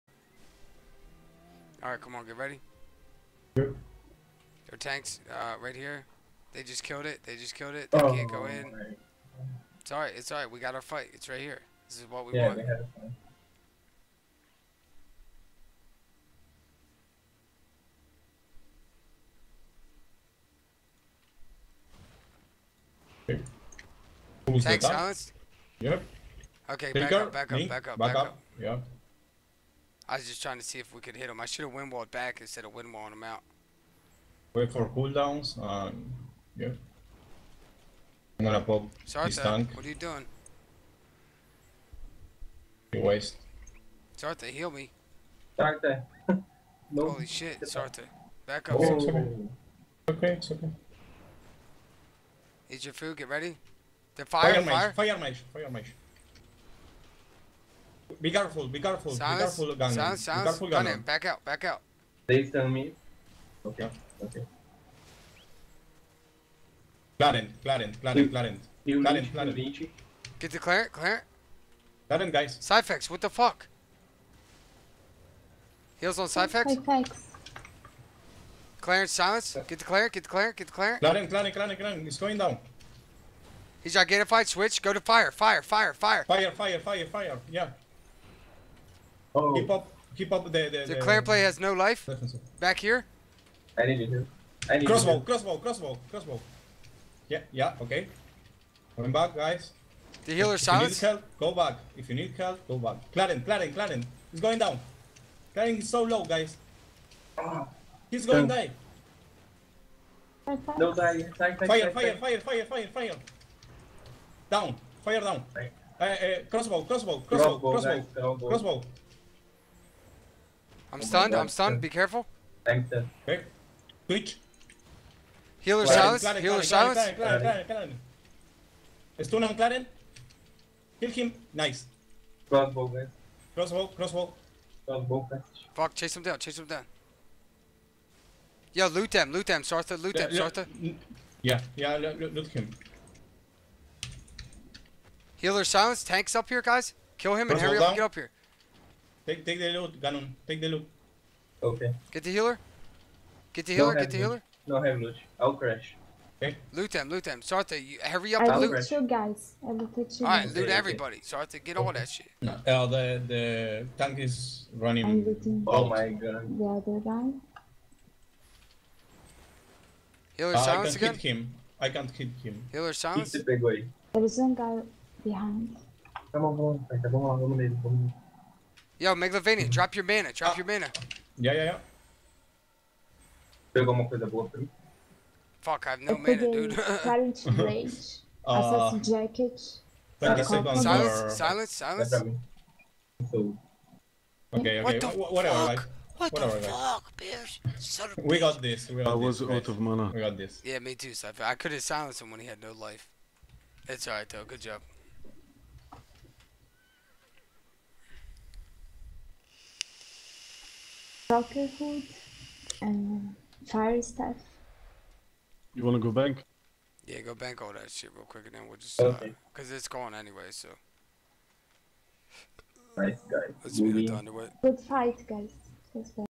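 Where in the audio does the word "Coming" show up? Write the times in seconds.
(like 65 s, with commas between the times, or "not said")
98 s.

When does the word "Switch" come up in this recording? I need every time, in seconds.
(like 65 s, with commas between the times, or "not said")
84 s.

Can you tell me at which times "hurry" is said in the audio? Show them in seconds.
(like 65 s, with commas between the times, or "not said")
147 s, 158 s.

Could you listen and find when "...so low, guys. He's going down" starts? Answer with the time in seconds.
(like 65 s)
105 s.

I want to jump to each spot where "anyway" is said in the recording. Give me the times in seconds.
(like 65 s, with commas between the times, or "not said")
220 s.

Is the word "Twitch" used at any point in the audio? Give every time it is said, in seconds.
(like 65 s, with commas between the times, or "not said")
124 s.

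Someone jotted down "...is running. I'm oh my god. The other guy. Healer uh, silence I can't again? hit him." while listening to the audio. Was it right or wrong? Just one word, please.
right.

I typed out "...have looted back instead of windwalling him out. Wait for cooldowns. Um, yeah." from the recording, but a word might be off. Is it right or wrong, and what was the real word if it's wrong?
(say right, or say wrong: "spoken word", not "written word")
wrong: "windwalled", not "looted".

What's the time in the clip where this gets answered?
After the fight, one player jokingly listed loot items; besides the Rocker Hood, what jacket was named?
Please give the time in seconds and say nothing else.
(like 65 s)
188 s.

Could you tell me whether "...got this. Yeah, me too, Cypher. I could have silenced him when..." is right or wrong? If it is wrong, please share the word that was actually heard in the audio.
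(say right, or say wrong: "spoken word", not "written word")
right.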